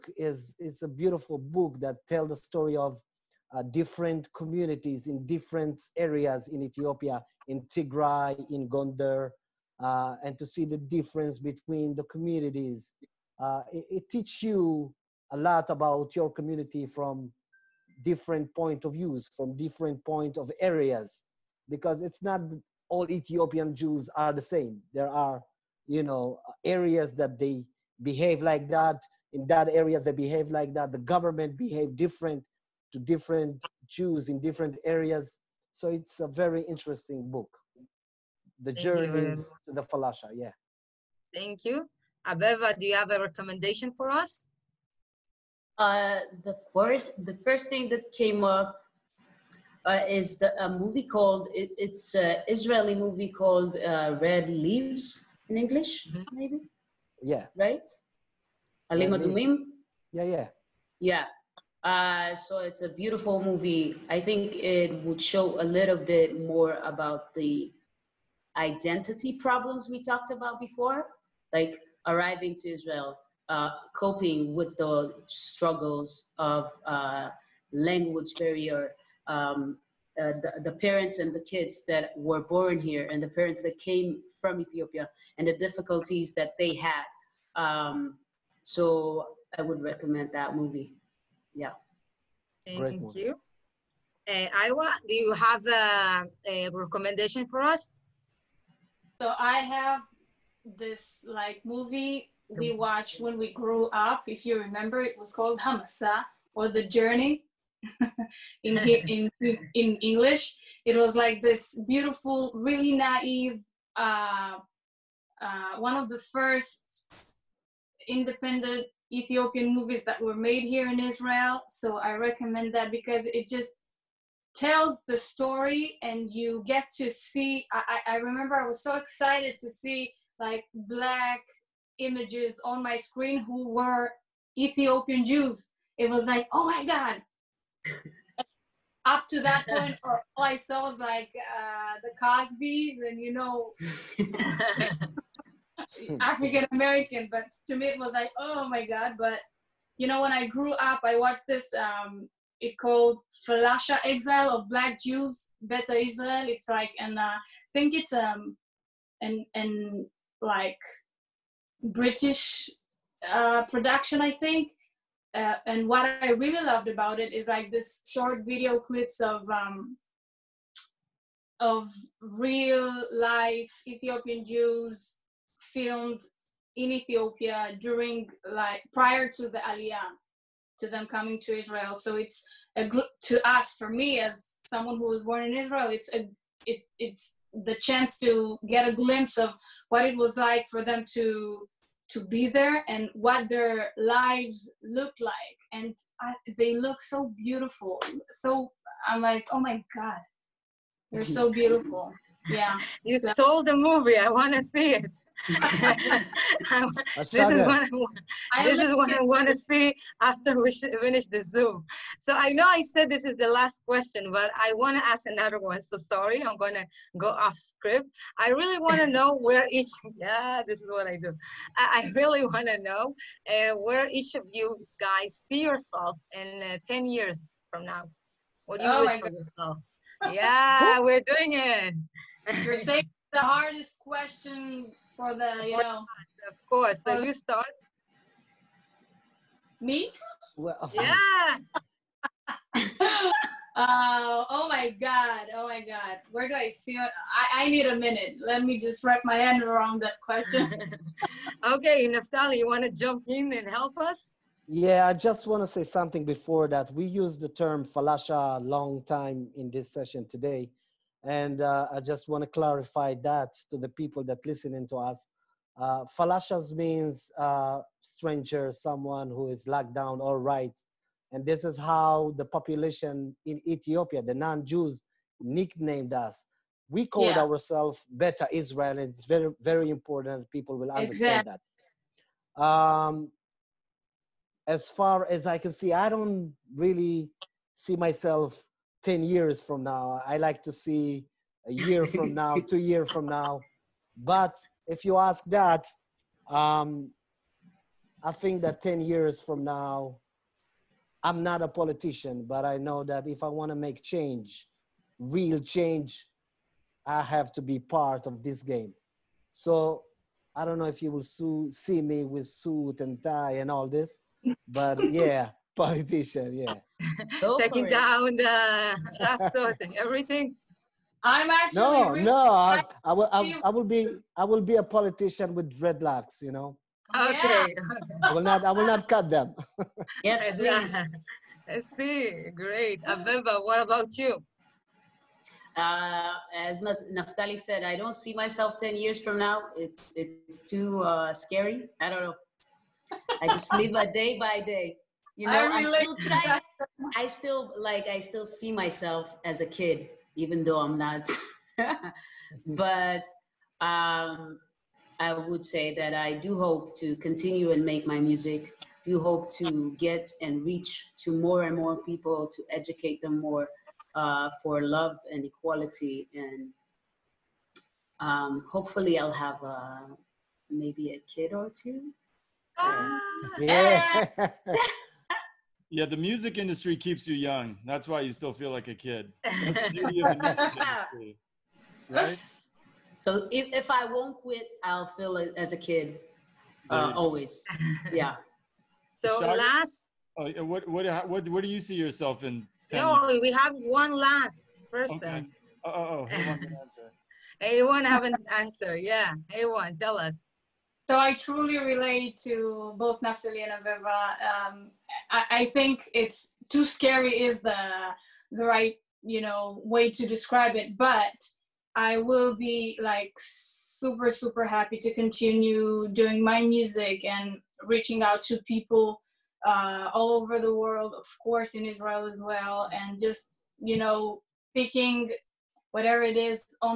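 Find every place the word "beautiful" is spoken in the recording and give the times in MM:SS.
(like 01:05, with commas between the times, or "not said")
00:00, 01:02, 01:51, 03:17, 03:21.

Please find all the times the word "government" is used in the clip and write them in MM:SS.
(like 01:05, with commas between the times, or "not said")
00:30.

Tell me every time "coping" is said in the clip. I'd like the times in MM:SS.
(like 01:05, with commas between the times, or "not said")
01:13.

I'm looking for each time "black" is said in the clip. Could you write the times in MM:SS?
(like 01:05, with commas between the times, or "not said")
02:10, 02:34.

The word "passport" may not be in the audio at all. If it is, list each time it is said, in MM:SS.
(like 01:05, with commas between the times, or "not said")
05:19.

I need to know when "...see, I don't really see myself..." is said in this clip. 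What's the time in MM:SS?
04:45.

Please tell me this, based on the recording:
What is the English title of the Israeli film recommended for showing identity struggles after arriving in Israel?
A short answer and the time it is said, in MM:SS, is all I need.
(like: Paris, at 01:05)
Red Leaves, at 00:54.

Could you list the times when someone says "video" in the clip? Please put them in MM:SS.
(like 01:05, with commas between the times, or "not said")
02:48.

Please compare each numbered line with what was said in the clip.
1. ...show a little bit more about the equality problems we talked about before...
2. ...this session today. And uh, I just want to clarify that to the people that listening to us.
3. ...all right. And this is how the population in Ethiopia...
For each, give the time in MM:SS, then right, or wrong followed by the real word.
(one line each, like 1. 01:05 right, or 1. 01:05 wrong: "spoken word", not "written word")
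1. 01:05 wrong: "identity", not "equality"
2. 04:19 right
3. 04:30 right.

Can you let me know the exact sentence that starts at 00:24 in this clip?
There are, you know, areas that they behave like that.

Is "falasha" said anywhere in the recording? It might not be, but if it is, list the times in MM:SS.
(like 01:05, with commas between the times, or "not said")
00:39, 02:33, 04:17, 04:26.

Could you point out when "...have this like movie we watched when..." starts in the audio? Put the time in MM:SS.
01:39.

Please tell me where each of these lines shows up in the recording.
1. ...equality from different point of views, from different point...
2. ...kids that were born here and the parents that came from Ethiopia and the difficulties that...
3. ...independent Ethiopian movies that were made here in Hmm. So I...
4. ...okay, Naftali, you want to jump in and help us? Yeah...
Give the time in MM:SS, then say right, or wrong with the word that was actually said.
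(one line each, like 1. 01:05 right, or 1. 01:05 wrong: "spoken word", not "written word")
1. 00:16 wrong: "community", not "equality"
2. 01:21 right
3. 01:58 wrong: "Israel", not "Hmm"
4. 04:11 right.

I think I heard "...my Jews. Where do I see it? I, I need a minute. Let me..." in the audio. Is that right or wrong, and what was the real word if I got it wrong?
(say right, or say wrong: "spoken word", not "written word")
wrong: "God", not "Jews".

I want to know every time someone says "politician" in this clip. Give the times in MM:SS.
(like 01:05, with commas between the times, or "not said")
05:01, 05:15, 05:24.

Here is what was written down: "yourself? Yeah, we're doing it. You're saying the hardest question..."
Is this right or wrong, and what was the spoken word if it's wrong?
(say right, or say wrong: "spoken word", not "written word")
right.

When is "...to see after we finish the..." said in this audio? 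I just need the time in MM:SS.
03:29.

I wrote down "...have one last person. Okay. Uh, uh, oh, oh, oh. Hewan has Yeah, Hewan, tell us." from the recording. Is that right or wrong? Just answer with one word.
right.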